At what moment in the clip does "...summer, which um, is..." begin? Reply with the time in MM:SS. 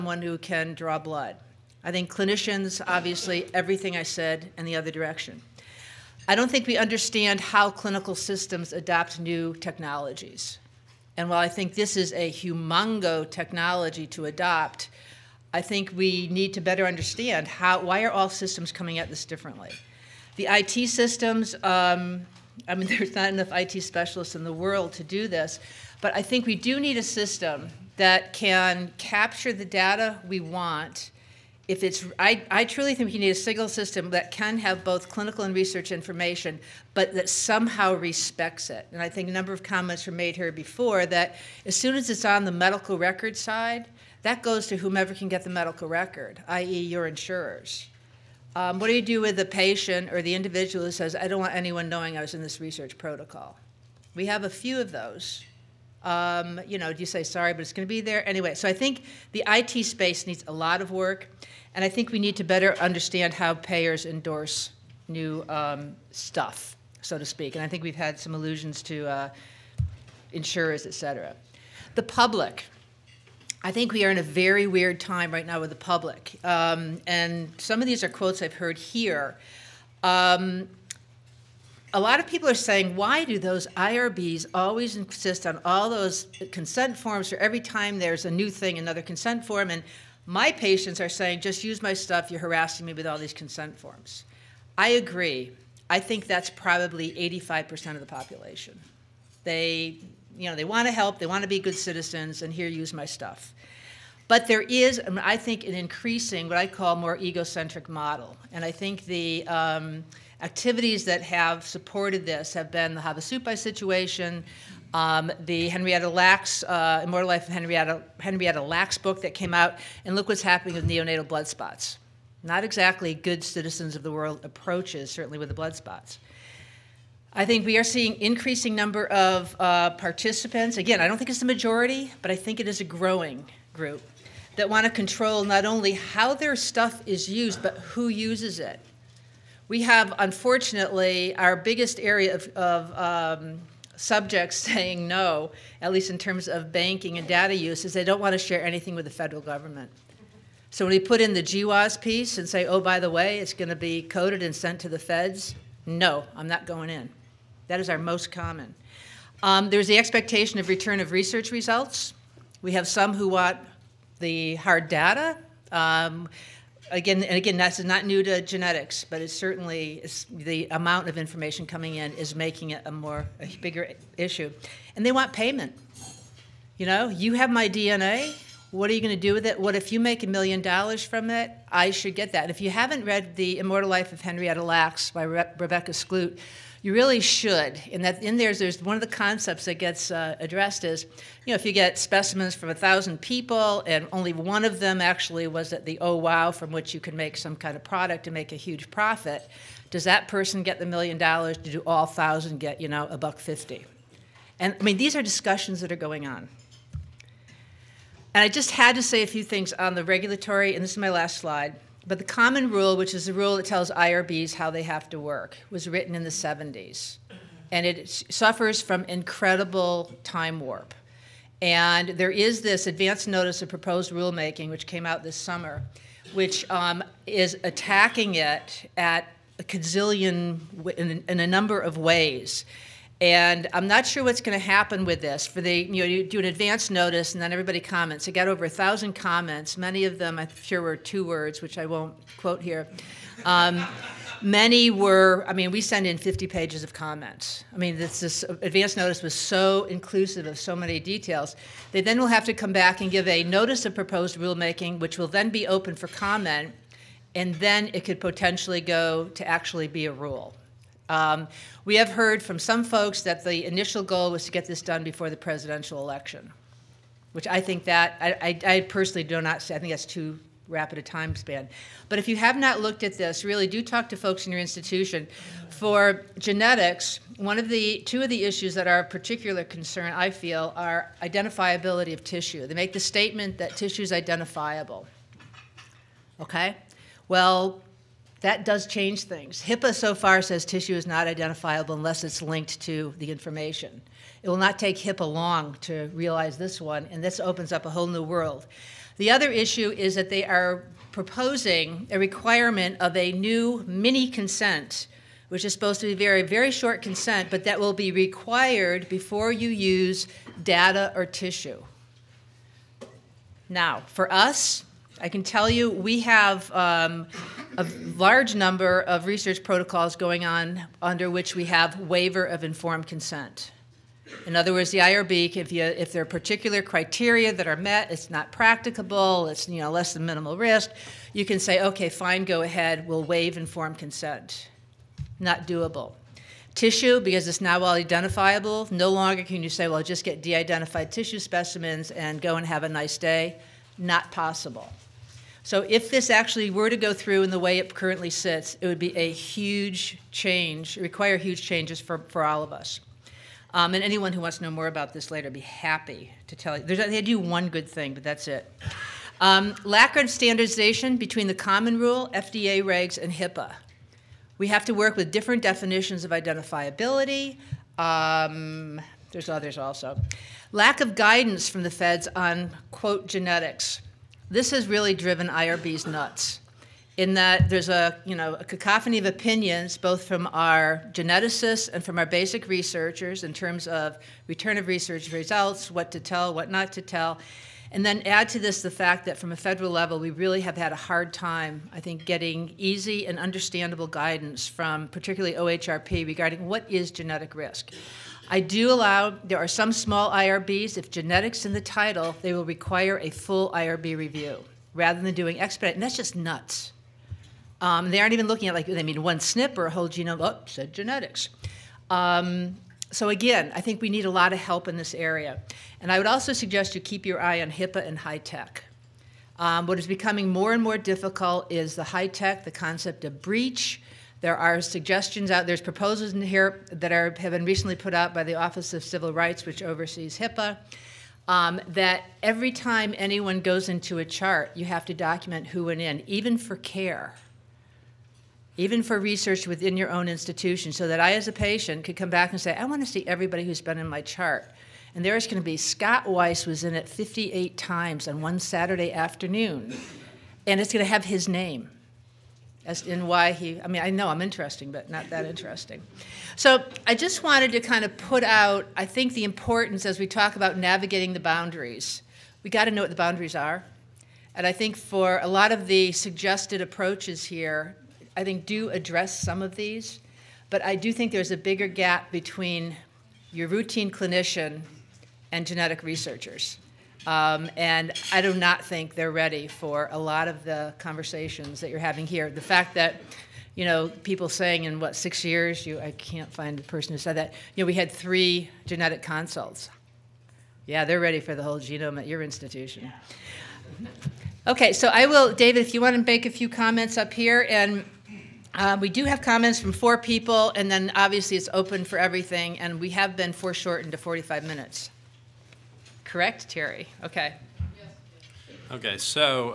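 03:45.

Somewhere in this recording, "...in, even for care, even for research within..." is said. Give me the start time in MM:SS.
07:15.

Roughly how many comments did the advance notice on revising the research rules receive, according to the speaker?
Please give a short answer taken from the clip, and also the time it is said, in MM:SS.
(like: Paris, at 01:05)
over 1,000, at 03:58.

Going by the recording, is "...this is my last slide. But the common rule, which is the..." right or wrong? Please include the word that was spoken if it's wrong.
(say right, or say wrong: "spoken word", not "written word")
right.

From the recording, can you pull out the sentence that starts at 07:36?
So I just wanted to kind of put out, I think, the importance as we talk about navigating the boundaries.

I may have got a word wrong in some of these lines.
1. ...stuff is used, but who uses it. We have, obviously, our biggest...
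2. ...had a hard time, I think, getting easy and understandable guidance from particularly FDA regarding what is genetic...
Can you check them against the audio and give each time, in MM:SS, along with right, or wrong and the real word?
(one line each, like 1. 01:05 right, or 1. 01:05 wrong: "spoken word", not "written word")
1. 02:16 wrong: "unfortunately", not "obviously"
2. 06:30 wrong: "OHRP", not "FDA".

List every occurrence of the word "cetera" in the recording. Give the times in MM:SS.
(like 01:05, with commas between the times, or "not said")
01:10.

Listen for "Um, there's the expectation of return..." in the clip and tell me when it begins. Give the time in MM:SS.
02:39.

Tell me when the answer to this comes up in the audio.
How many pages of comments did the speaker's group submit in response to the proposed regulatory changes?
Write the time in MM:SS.
04:06.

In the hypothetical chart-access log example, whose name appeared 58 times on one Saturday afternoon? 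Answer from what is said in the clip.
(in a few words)
Scott Weiss.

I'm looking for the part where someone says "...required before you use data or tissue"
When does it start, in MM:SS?
05:08.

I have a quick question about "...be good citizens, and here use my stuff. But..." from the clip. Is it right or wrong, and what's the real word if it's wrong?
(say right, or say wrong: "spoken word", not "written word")
right.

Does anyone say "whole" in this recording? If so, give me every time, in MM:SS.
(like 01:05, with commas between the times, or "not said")
04:57, 06:49, 08:11.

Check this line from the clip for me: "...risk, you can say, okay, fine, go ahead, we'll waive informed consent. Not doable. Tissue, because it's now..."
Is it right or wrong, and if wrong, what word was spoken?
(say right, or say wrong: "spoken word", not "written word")
right.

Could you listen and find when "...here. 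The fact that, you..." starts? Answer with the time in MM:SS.
08:02.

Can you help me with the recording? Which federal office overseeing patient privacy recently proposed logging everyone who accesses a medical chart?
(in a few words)
Office of Civil Rights.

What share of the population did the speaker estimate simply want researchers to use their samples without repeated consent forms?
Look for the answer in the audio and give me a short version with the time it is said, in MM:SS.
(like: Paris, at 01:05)
85%, at 01:37.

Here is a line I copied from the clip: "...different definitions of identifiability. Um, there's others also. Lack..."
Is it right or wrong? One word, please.
right.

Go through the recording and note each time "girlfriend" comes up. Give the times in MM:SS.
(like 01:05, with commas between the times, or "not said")
not said.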